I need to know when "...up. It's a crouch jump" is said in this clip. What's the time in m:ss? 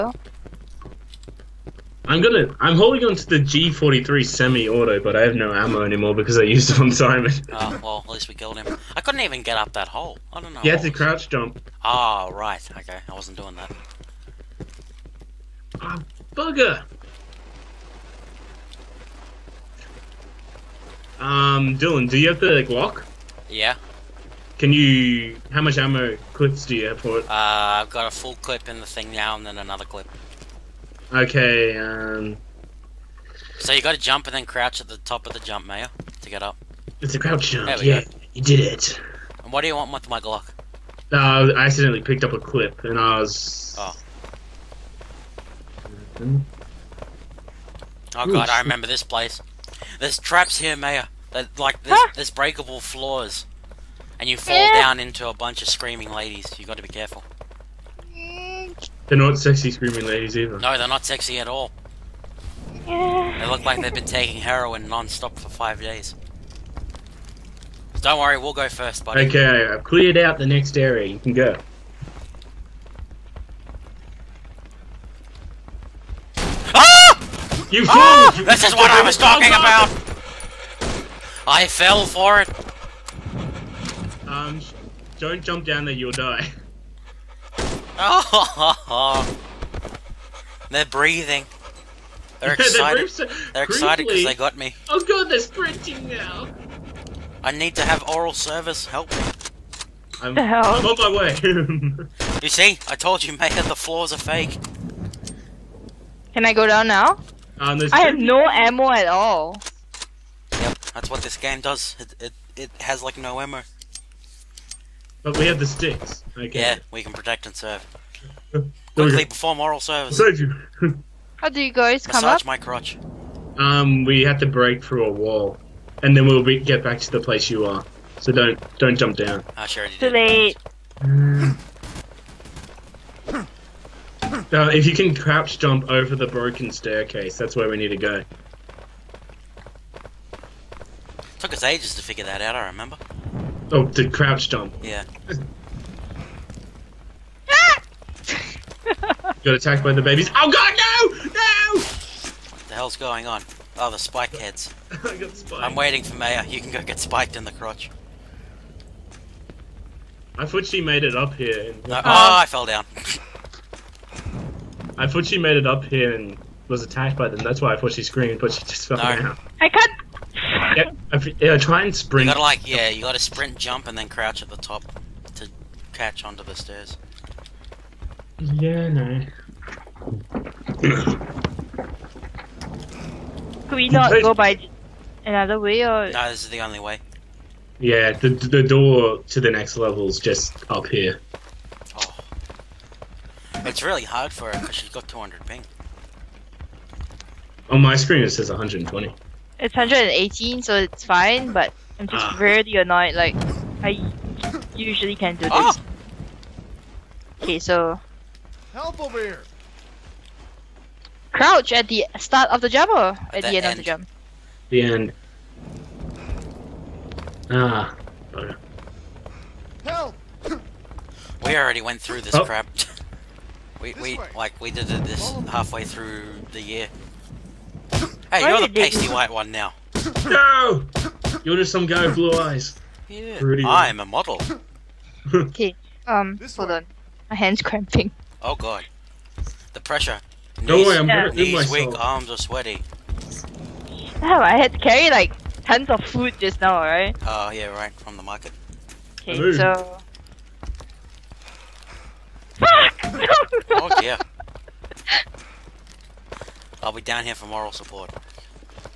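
0:36.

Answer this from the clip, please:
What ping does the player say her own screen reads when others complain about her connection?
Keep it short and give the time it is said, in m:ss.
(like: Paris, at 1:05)
120, at 3:18.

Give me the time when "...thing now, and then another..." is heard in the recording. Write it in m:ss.
0:28.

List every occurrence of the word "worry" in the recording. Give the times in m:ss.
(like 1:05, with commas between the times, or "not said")
1:08, 4:00.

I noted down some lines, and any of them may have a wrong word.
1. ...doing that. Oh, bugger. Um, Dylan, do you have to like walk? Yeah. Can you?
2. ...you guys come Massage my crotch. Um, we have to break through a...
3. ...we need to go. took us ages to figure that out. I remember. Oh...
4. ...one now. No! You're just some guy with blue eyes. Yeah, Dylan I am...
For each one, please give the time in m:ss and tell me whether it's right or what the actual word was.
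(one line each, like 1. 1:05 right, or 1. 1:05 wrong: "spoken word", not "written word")
1. 0:13 right
2. 2:01 right
3. 2:17 right
4. 3:49 wrong: "Pretty", not "Dylan".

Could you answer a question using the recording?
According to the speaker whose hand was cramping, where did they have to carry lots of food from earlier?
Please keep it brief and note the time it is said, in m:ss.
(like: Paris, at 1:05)
The market, at 4:08.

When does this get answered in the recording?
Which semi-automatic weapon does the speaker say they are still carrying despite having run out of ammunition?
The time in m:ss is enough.
0:03.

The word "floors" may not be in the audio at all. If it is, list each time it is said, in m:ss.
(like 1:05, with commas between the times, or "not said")
0:52, 1:43.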